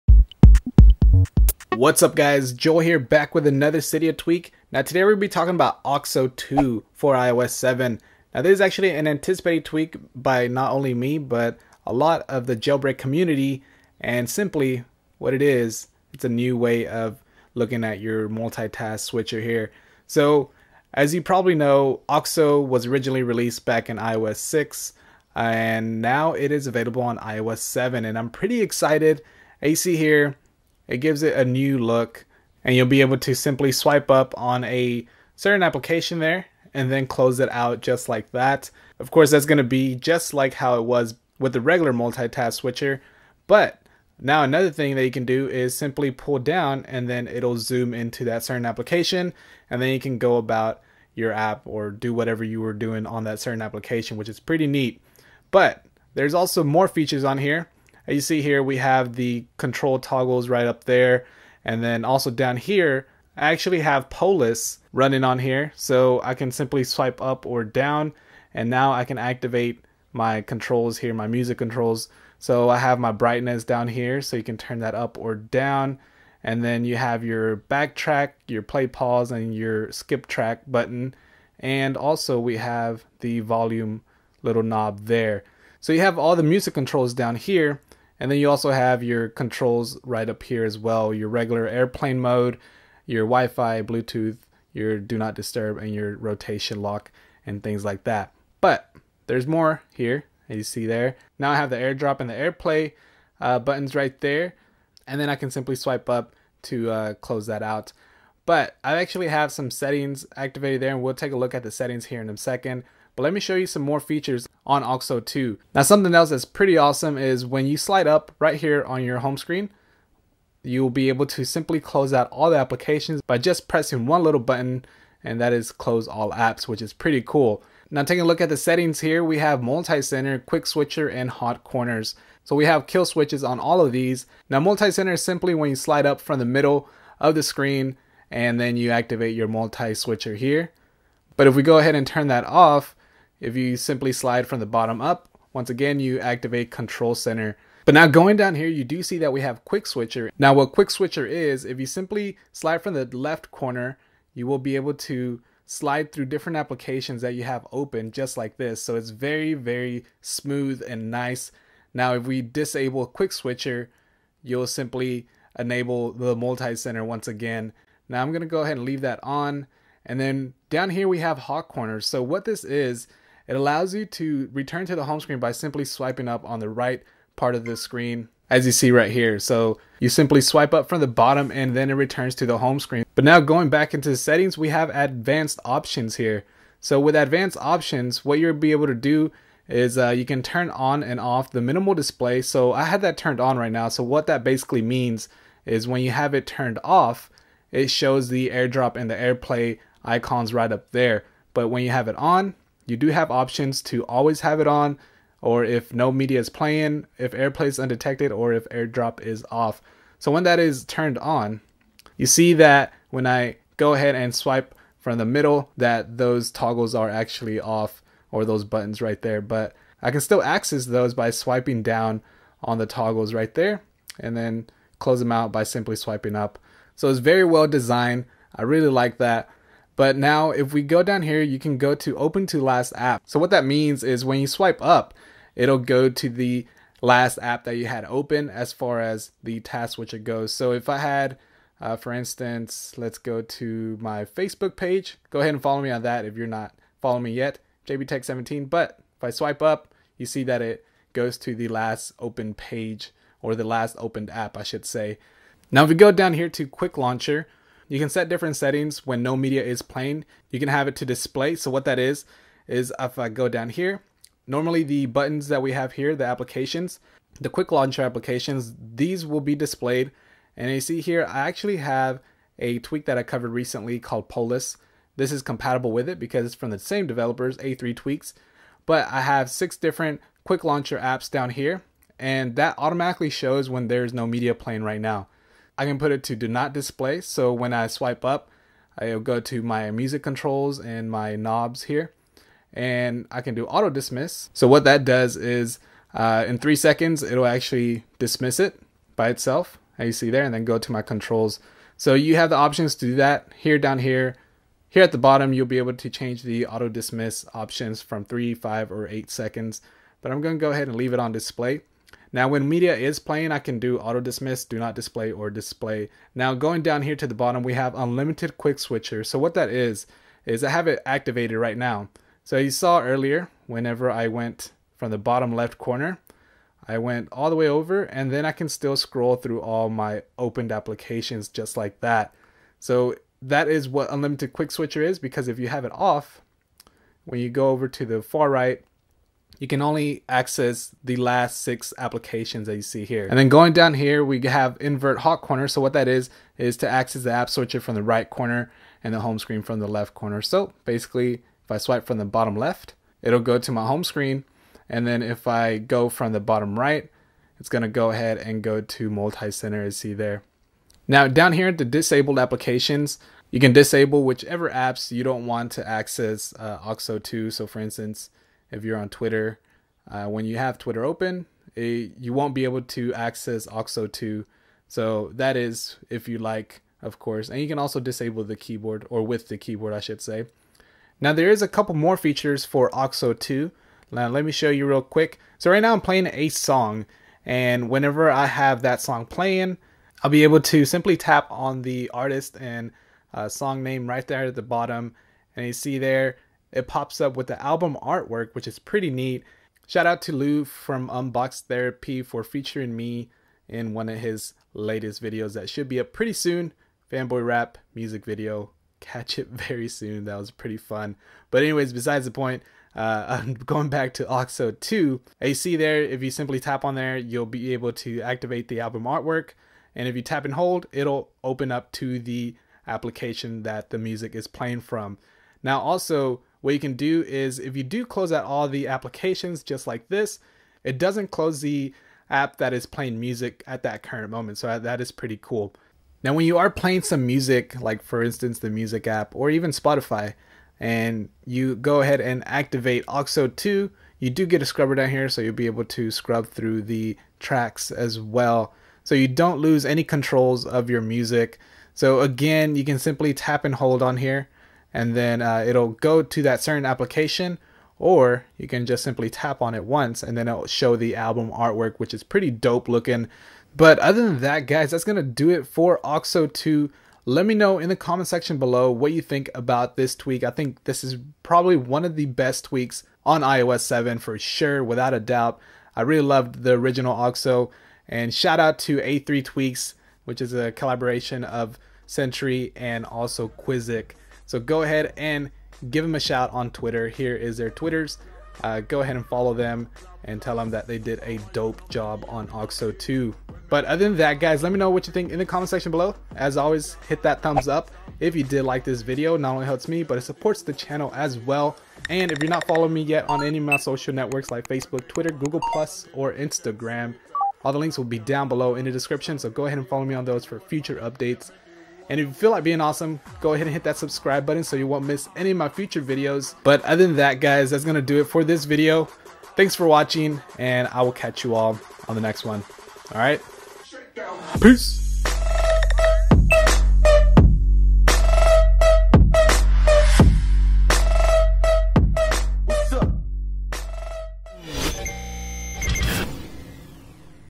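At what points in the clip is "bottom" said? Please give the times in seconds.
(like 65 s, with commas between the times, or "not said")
144 s, 181 s, 305 s, 317 s, 325 s, 352 s, 356 s, 394 s.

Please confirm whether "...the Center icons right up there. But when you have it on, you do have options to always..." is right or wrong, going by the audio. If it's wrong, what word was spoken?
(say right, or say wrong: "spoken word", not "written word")
wrong: "AirPlay", not "Center".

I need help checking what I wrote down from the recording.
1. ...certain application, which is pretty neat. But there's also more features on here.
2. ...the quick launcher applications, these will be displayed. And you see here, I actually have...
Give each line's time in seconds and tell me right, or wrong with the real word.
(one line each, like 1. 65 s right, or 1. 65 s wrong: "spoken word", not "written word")
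1. 53 s right
2. 267 s right.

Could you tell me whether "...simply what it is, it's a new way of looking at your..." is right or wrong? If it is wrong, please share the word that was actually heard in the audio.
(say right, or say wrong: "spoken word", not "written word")
right.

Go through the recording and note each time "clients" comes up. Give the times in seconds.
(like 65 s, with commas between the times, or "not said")
not said.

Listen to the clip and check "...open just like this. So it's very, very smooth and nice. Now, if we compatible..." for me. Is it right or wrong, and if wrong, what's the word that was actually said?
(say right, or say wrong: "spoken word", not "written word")
wrong: "disable", not "compatible".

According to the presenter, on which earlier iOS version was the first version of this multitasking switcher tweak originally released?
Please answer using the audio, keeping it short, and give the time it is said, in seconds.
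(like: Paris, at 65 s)
iOS 6, at 23 s.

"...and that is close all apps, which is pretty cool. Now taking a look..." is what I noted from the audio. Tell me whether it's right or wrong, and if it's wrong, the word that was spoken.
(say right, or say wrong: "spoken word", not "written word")
right.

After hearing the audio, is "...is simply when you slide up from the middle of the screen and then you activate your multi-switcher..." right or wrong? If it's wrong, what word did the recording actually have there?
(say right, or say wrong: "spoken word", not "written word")
right.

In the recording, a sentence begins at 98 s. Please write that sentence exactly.
But there's more here, as you see there.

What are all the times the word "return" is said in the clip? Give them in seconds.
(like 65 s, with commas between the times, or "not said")
174 s, 181 s.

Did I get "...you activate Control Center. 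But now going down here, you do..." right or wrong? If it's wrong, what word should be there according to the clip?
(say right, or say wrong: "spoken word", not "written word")
right.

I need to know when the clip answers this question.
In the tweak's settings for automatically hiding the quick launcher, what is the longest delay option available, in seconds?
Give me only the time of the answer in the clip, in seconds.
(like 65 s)
309 s.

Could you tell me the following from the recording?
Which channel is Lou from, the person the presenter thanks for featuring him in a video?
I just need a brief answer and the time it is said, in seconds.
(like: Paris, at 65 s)
Unbox Therapy, at 401 s.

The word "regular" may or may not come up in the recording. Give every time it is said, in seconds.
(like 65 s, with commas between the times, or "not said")
41 s, 91 s.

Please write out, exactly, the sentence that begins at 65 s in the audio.
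So I can simply swipe up or down.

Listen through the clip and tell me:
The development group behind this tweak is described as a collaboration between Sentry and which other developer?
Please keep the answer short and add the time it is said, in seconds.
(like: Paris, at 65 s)
Qusic, at 483 s.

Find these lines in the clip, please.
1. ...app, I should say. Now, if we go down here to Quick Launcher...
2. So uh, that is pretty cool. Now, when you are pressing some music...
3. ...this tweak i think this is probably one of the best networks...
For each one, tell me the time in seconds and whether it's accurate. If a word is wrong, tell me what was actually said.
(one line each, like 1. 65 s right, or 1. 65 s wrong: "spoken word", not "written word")
1. 254 s right
2. 434 s wrong: "playing", not "pressing"
3. 469 s wrong: "tweaks", not "networks".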